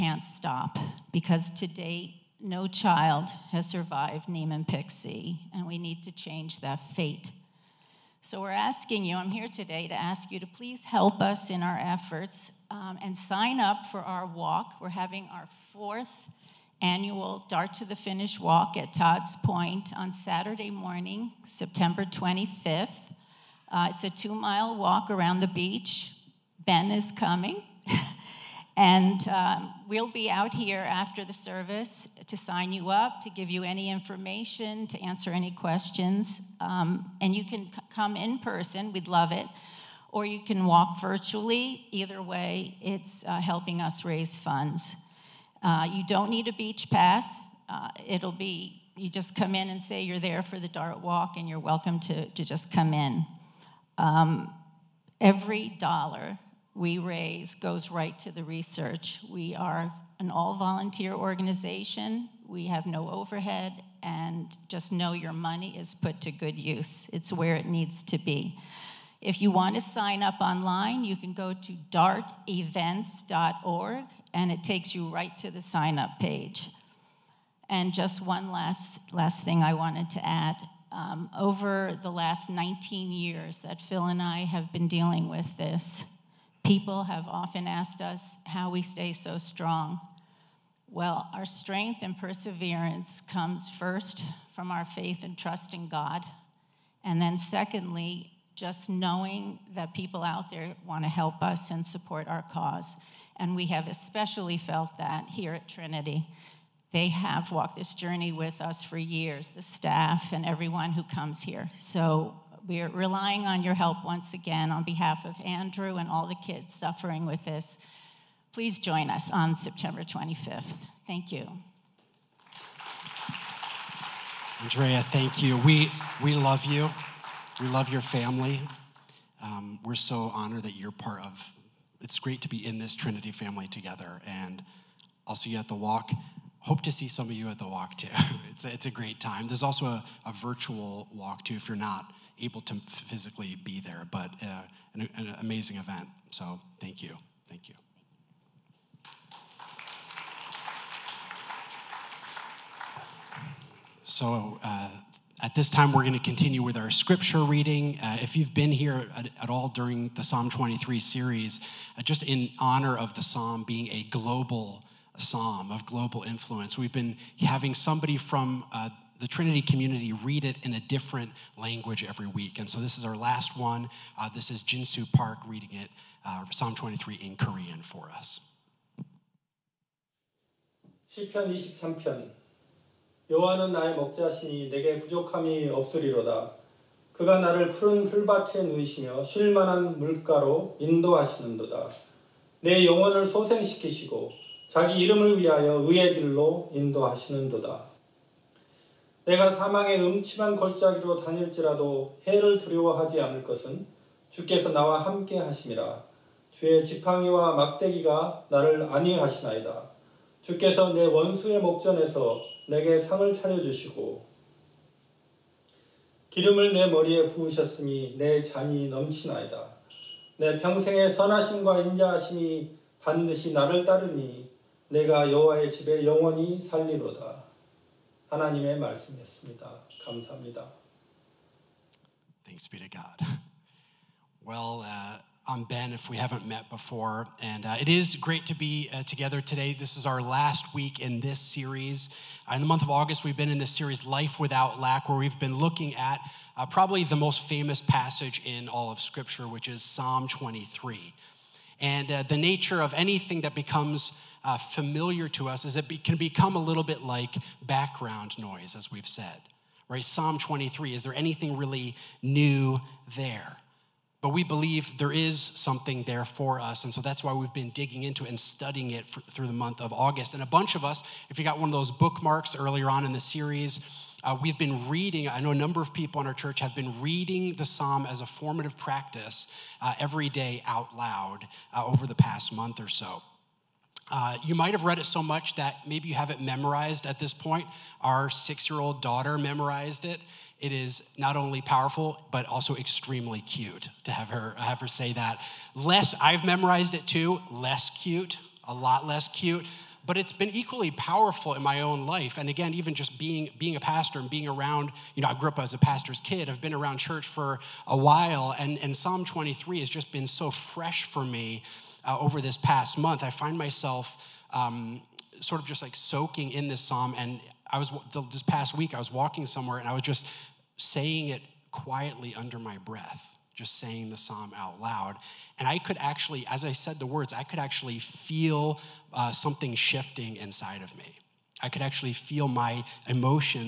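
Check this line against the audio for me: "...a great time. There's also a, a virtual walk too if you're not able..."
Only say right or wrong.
right.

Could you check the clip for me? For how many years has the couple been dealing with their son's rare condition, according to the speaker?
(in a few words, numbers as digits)
19.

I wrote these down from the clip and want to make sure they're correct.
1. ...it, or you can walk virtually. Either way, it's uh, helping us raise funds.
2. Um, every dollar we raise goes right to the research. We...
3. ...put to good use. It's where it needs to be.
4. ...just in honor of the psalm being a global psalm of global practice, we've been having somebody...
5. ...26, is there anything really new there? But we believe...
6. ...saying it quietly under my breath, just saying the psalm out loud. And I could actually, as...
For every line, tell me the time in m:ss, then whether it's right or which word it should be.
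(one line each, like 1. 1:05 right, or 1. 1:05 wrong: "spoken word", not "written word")
1. 0:39 right
2. 0:53 right
3. 1:05 right
4. 2:42 wrong: "influence", not "practice"
5. 4:20 wrong: "23", not "26"
6. 5:20 right.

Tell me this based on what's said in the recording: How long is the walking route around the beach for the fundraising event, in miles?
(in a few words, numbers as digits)
2 miles.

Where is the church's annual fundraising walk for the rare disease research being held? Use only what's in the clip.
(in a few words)
Todd's Point.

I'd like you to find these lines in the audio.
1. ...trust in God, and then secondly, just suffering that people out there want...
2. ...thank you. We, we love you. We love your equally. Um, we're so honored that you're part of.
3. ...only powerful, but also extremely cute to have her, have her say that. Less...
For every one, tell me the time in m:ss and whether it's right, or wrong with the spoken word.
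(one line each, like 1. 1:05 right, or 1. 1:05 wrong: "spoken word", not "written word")
1. 1:35 wrong: "knowing", not "suffering"
2. 2:05 wrong: "family", not "equally"
3. 4:51 right.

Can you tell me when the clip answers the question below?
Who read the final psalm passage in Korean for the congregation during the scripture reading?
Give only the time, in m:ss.
2:54.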